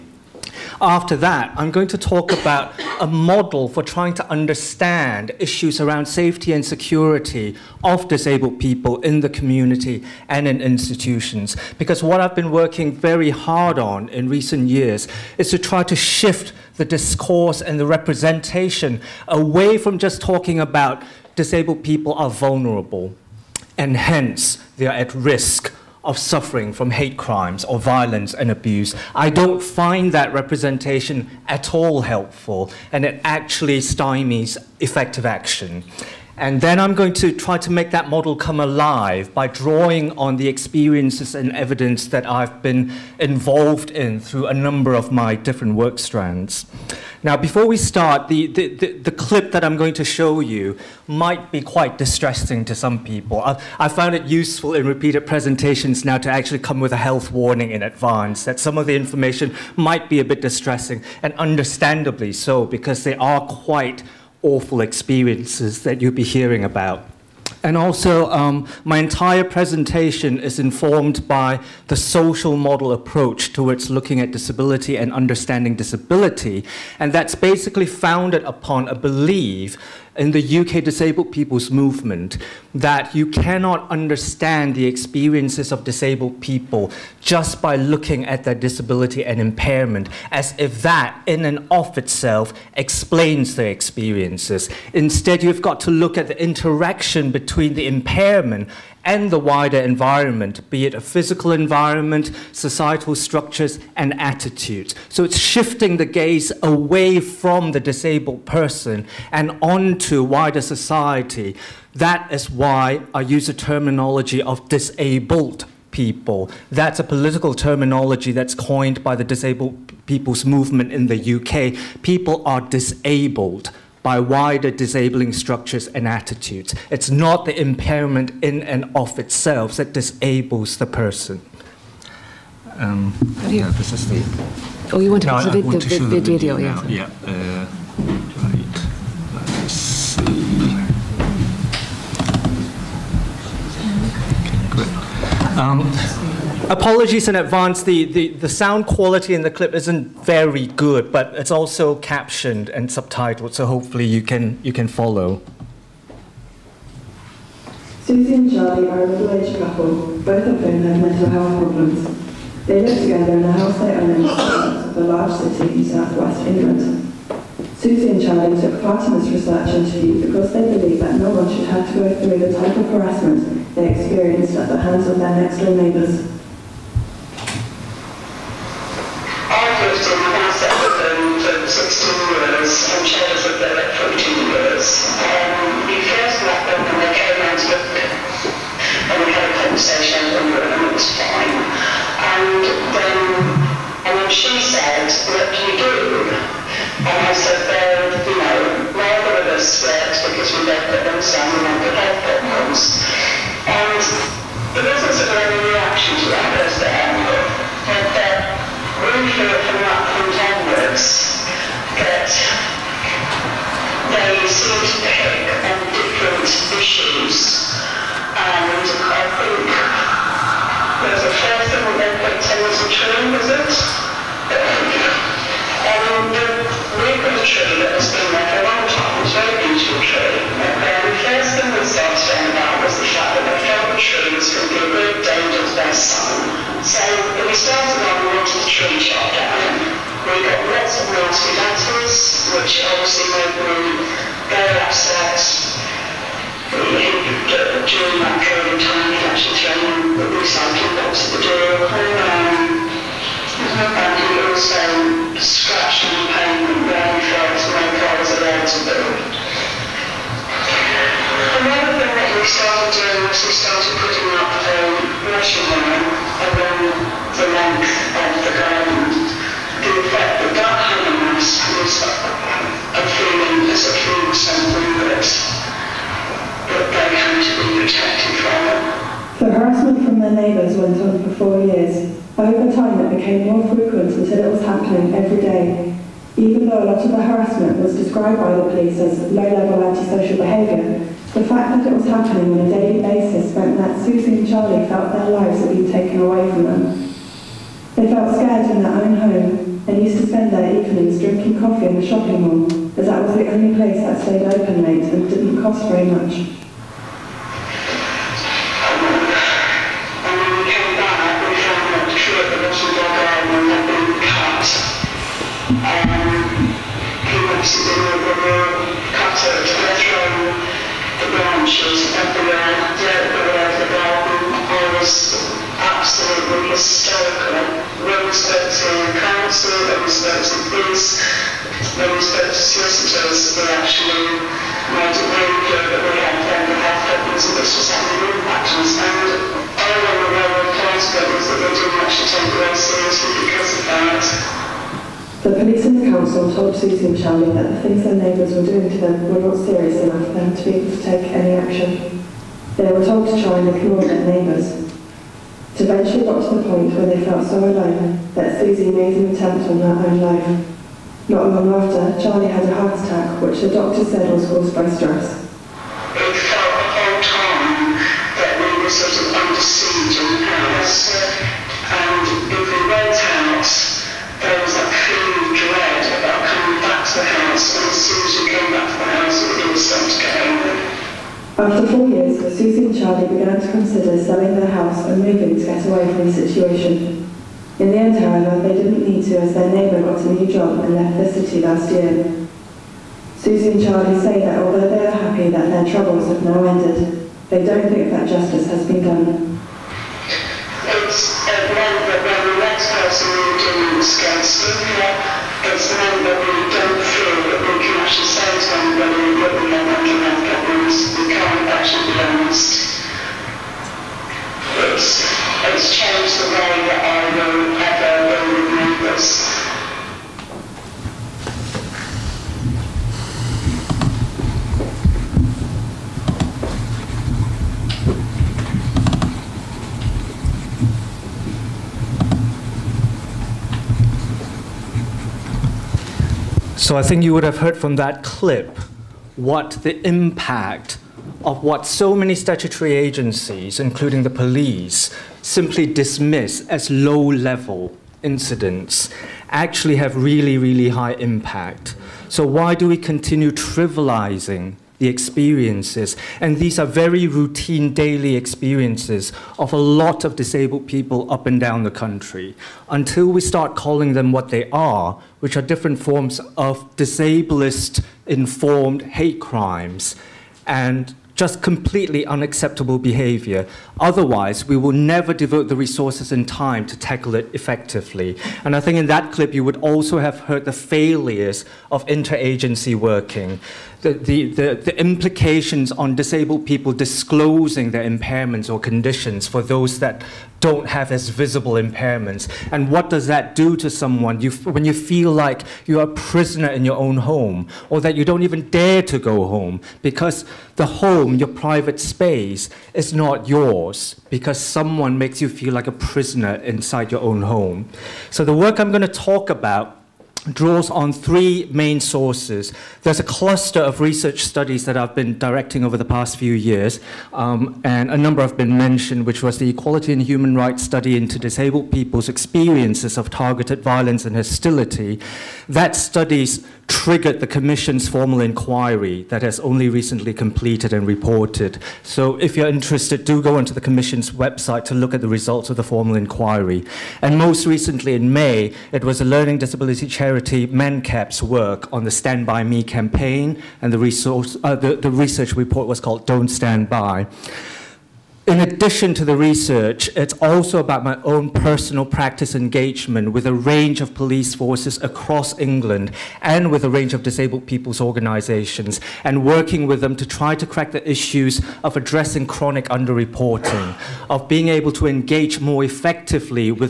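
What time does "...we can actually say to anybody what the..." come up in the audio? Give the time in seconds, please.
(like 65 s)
407 s.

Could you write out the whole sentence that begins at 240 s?
We get lots of nasty letters, which obviously made them very upset.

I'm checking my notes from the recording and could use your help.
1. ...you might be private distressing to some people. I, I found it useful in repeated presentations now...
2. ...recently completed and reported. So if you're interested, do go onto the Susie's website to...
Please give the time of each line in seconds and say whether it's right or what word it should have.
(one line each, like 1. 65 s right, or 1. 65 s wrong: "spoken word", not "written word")
1. 50 s wrong: "quite", not "private"
2. 529 s wrong: "Commission", not "Susie".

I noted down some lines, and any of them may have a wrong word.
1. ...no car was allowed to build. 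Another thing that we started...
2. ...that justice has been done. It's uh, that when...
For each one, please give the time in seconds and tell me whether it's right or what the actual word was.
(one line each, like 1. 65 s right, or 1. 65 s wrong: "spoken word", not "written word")
1. 257 s right
2. 398 s right.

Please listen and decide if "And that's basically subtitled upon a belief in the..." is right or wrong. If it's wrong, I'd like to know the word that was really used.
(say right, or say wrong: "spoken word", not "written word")
wrong: "founded", not "subtitled".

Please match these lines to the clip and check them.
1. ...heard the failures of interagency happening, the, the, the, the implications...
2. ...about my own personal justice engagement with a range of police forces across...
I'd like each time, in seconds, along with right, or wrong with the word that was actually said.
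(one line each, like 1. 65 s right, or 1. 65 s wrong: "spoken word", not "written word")
1. 480 s wrong: "working", not "happening"
2. 550 s wrong: "practice", not "justice".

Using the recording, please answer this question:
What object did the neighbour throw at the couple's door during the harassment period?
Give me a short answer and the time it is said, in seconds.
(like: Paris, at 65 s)
recycling box, at 250 s.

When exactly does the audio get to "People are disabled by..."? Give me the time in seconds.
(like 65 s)
122 s.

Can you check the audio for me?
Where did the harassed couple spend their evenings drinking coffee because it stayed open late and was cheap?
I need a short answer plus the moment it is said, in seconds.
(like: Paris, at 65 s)
shopping mall, at 302 s.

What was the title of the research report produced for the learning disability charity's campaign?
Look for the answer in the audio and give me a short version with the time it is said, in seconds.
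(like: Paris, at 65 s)
Don't Stand By, at 546 s.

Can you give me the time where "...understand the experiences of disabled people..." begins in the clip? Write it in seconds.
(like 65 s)
83 s.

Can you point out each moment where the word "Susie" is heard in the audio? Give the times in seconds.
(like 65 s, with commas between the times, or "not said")
158 s, 167 s, 294 s, 346 s, 358 s, 382 s, 393 s.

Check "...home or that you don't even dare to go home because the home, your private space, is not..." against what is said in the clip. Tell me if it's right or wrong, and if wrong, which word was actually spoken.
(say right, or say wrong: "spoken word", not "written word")
right.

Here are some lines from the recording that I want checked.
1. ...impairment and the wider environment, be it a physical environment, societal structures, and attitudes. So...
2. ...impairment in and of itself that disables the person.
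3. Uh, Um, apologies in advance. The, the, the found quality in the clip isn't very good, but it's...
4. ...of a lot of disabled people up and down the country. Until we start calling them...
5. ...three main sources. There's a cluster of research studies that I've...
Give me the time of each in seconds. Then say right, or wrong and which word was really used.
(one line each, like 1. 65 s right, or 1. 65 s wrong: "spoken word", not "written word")
1. 97 s right
2. 127 s right
3. 137 s wrong: "sound", not "found"
4. 459 s right
5. 511 s right.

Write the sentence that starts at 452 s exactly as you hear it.
So, why do we continue trivializing the experiences.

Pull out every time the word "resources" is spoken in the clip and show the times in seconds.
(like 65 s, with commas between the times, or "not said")
475 s, 543 s.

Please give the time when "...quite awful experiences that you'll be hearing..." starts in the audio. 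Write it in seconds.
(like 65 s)
63 s.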